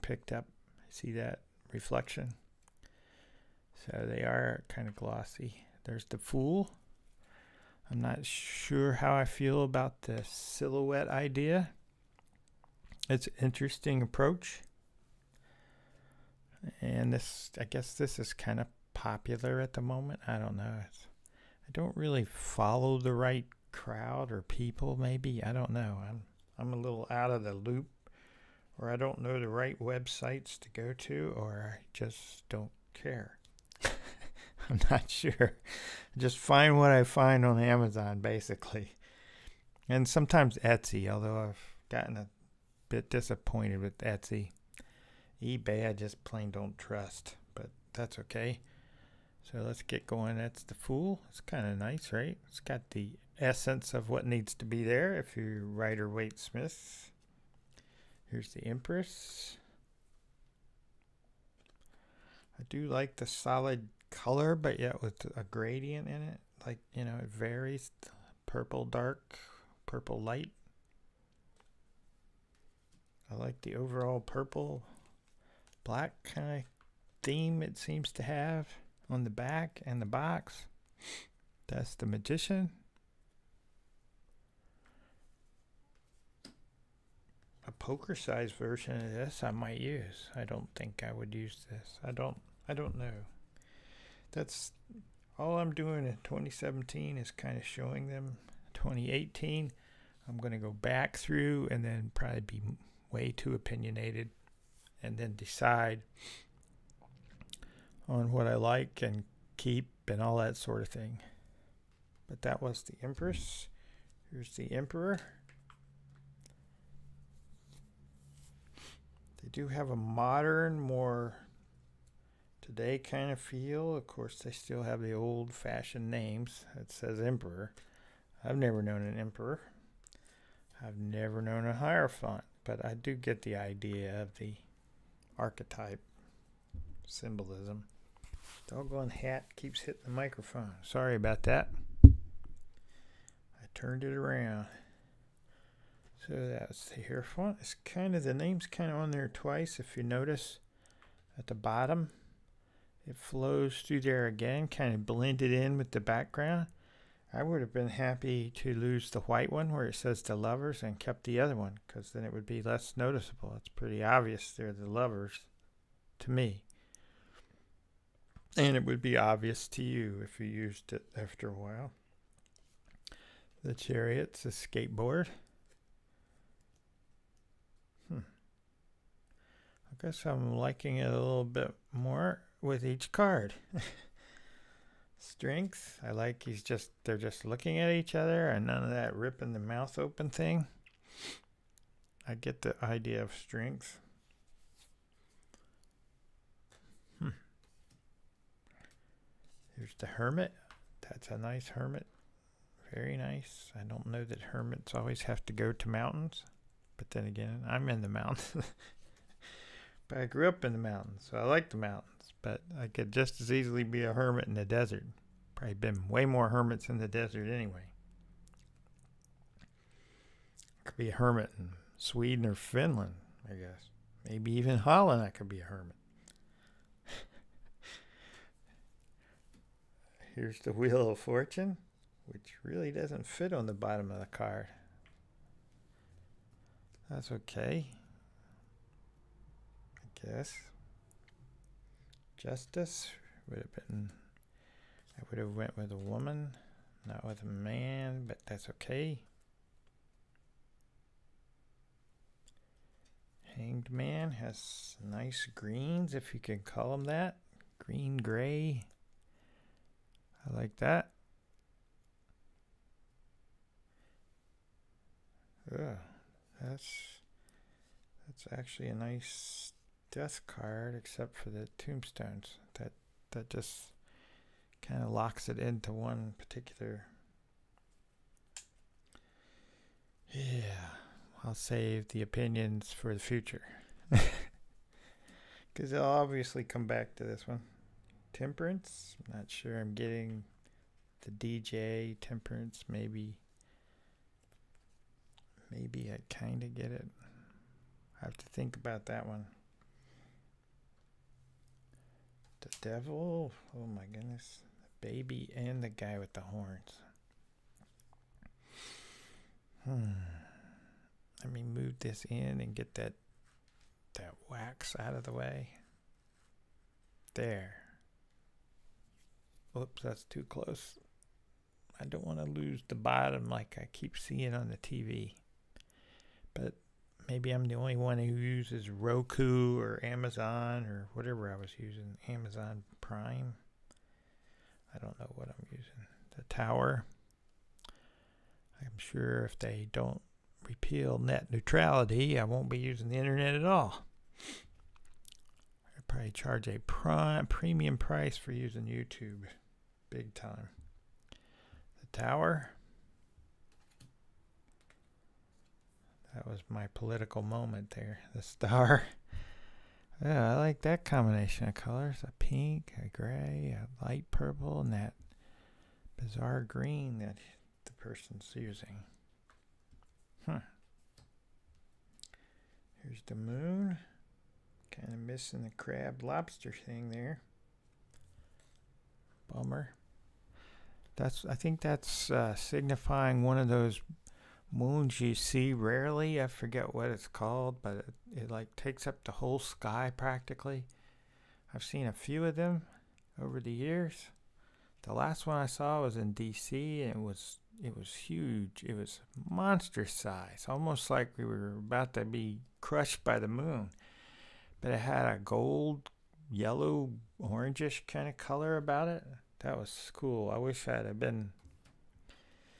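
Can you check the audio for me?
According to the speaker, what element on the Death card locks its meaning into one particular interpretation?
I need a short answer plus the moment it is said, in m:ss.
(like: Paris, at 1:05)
The tombstones, at 4:31.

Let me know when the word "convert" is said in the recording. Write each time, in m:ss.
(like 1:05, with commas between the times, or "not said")
not said.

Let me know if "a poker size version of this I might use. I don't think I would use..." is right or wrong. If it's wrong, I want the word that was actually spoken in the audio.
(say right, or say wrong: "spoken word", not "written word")
right.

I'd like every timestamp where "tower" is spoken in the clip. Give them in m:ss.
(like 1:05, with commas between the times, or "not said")
5:36, 5:52.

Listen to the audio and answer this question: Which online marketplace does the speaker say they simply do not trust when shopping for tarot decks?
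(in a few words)
eBay.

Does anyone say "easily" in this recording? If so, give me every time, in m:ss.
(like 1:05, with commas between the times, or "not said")
3:33.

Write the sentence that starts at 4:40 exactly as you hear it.
Yeah, I'll save the opinions for the future.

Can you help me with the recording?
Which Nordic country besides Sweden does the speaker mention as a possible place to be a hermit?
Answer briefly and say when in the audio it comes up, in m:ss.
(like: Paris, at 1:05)
Finland, at 3:42.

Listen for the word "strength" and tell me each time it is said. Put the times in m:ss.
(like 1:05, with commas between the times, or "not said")
3:05, 3:13.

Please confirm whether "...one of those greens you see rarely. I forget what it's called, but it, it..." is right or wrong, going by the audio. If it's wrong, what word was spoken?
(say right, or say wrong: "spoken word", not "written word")
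wrong: "moons", not "greens".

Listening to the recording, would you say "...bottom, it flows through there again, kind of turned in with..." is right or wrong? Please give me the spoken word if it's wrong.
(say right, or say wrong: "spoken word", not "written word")
wrong: "blended", not "turned".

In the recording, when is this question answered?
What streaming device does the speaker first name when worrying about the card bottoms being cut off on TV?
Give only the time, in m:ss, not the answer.
5:28.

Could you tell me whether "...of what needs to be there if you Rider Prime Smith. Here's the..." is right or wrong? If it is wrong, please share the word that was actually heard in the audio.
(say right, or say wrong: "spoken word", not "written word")
wrong: "Waite", not "Prime".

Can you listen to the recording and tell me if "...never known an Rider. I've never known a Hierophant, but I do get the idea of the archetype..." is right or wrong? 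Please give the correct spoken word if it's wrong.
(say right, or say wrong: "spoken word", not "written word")
wrong: "Emperor", not "Rider".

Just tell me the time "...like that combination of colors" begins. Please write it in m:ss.
6:00.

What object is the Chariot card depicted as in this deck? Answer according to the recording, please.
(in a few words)
A skateboard.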